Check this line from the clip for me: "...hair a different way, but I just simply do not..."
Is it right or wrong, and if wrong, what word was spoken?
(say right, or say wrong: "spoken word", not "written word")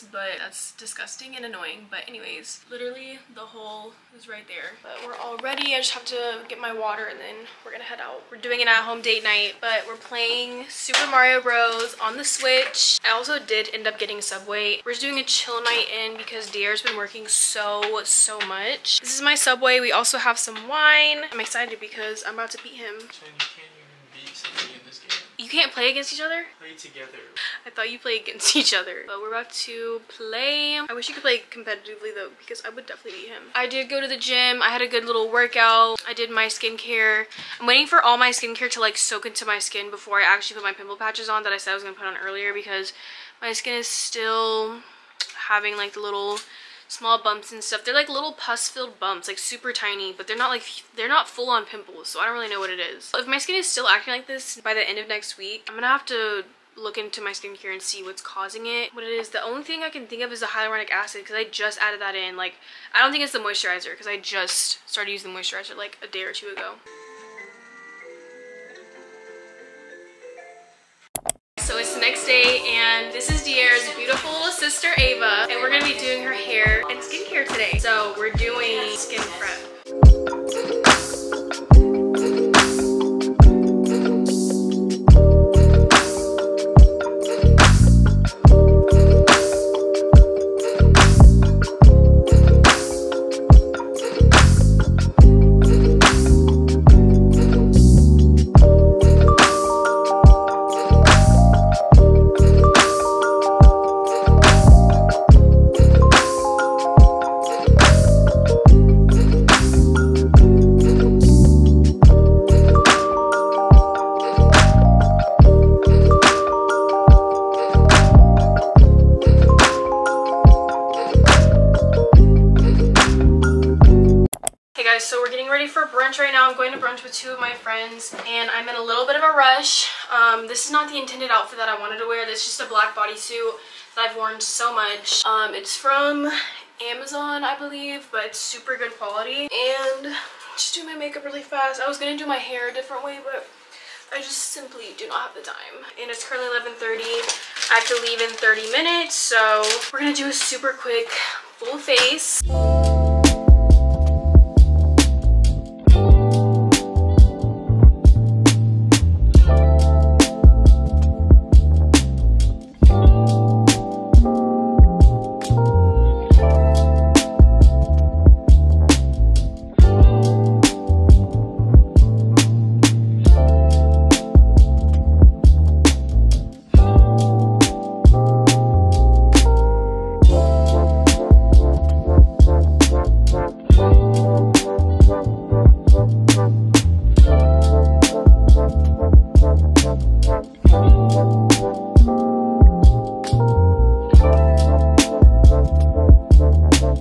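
right.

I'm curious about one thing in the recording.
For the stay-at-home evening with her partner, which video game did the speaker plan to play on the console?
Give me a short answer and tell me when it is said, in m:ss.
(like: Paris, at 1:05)
Super Mario Bros., at 0:10.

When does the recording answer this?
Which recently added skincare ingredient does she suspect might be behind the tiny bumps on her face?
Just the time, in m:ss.
1:00.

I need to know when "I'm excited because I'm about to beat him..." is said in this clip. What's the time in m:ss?
0:21.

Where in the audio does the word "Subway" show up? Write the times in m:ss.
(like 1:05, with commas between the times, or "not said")
0:14, 0:19.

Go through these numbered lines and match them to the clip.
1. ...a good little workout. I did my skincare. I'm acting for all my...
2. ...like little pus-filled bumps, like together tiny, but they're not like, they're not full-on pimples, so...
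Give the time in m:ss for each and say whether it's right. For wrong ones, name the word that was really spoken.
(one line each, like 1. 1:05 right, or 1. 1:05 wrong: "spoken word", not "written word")
1. 0:34 wrong: "waiting", not "acting"
2. 0:47 wrong: "super", not "together".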